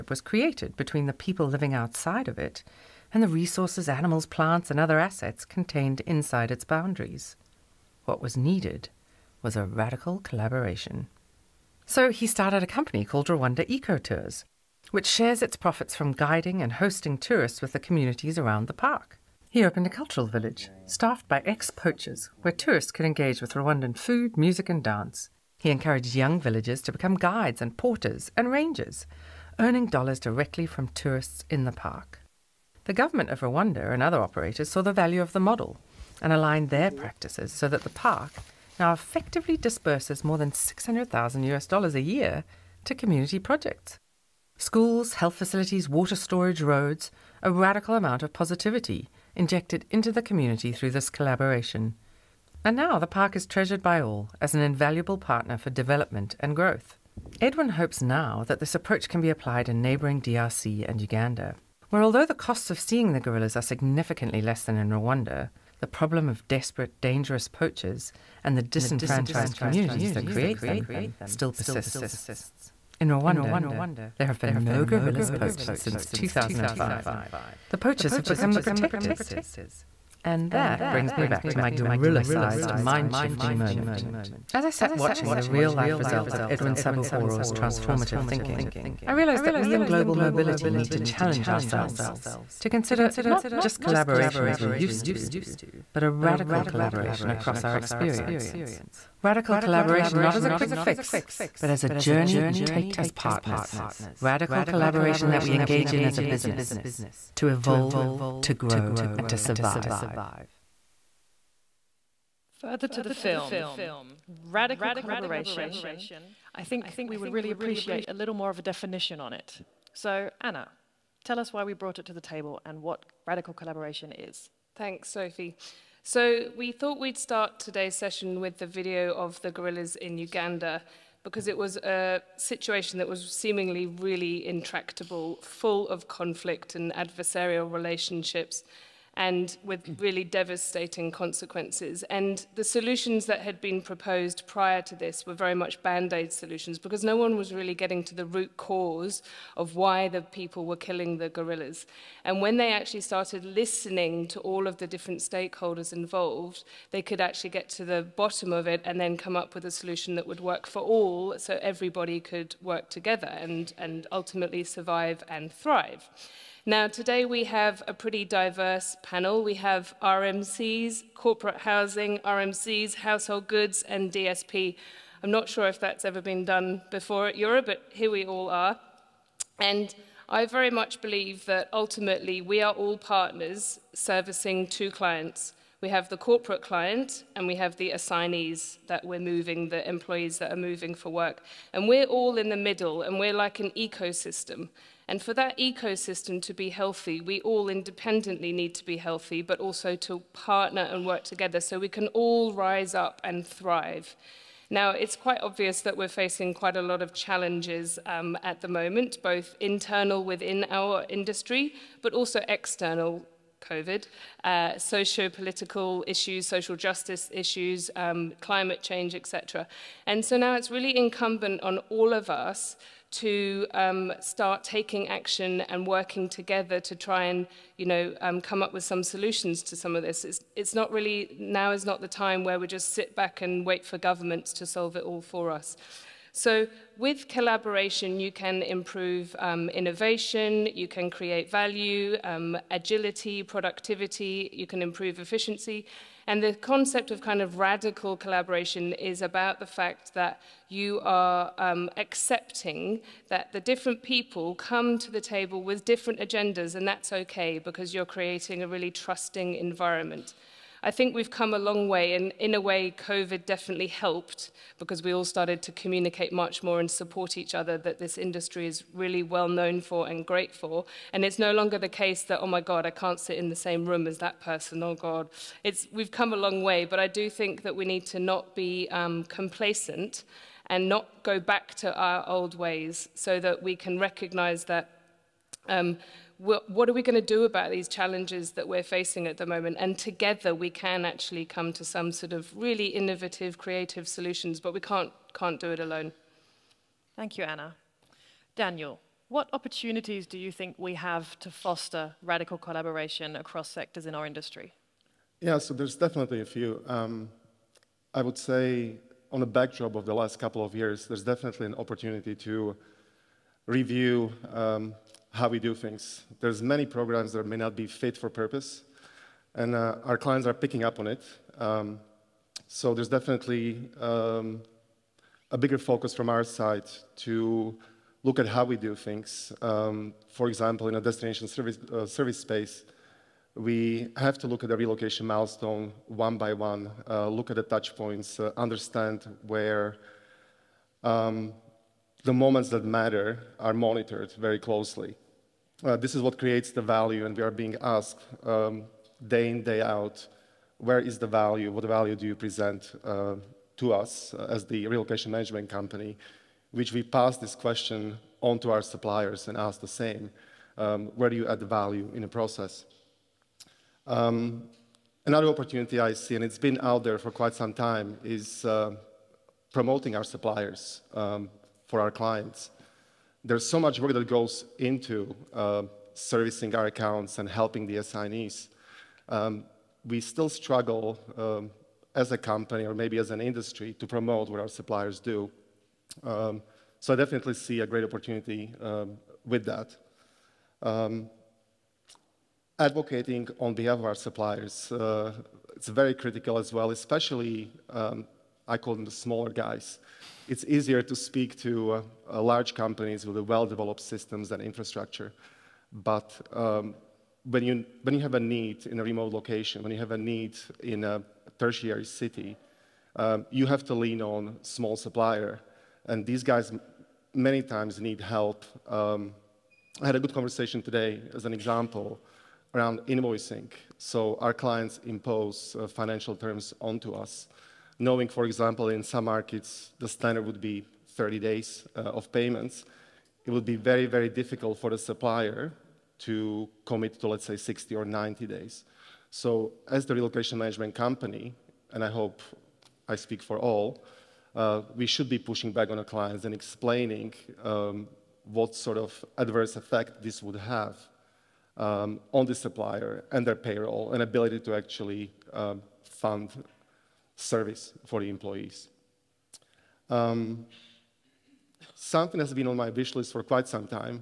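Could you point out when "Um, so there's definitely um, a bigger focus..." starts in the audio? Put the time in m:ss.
5:21.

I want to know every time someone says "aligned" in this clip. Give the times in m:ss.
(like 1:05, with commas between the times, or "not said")
0:36.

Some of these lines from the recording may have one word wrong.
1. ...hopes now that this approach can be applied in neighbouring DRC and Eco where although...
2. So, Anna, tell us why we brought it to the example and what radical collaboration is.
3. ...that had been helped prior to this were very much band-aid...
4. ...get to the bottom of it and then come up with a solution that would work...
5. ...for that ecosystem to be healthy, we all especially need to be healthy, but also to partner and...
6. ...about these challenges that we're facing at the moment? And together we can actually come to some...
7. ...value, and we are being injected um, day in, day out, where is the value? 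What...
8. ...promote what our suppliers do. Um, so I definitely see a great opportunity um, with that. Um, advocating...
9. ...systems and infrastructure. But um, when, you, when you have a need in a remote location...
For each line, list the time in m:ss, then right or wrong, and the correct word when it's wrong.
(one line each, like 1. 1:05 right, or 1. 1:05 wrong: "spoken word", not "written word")
1. 0:57 wrong: "Uganda", not "Eco"
2. 1:59 wrong: "table", not "example"
3. 2:23 wrong: "proposed", not "helped"
4. 2:37 right
5. 3:15 wrong: "independently", not "especially"
6. 4:47 right
7. 5:46 wrong: "asked", not "injected"
8. 6:24 right
9. 6:43 right.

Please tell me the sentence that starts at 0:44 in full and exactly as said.
Schools, health facilities, water storage, roads, a radical amount of positivity injected into the community through this collaboration.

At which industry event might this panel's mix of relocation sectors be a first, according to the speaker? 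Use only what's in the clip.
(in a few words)
EuRA.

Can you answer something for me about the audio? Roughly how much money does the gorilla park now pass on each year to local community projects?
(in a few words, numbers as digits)
600,000 US dollars.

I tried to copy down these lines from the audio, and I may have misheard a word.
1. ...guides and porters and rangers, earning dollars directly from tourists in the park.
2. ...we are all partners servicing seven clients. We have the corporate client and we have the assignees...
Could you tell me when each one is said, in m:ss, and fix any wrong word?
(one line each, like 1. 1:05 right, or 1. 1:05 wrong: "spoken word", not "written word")
1. 0:27 right
2. 3:02 wrong: "two", not "seven".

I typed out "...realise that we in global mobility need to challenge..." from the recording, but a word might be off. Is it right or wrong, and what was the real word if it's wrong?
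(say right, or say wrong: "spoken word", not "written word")
right.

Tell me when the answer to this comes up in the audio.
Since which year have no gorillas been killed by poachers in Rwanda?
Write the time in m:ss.
1:16.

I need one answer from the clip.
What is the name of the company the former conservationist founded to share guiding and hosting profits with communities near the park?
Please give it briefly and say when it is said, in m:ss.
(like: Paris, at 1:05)
Rwanda Eco Tours, at 0:13.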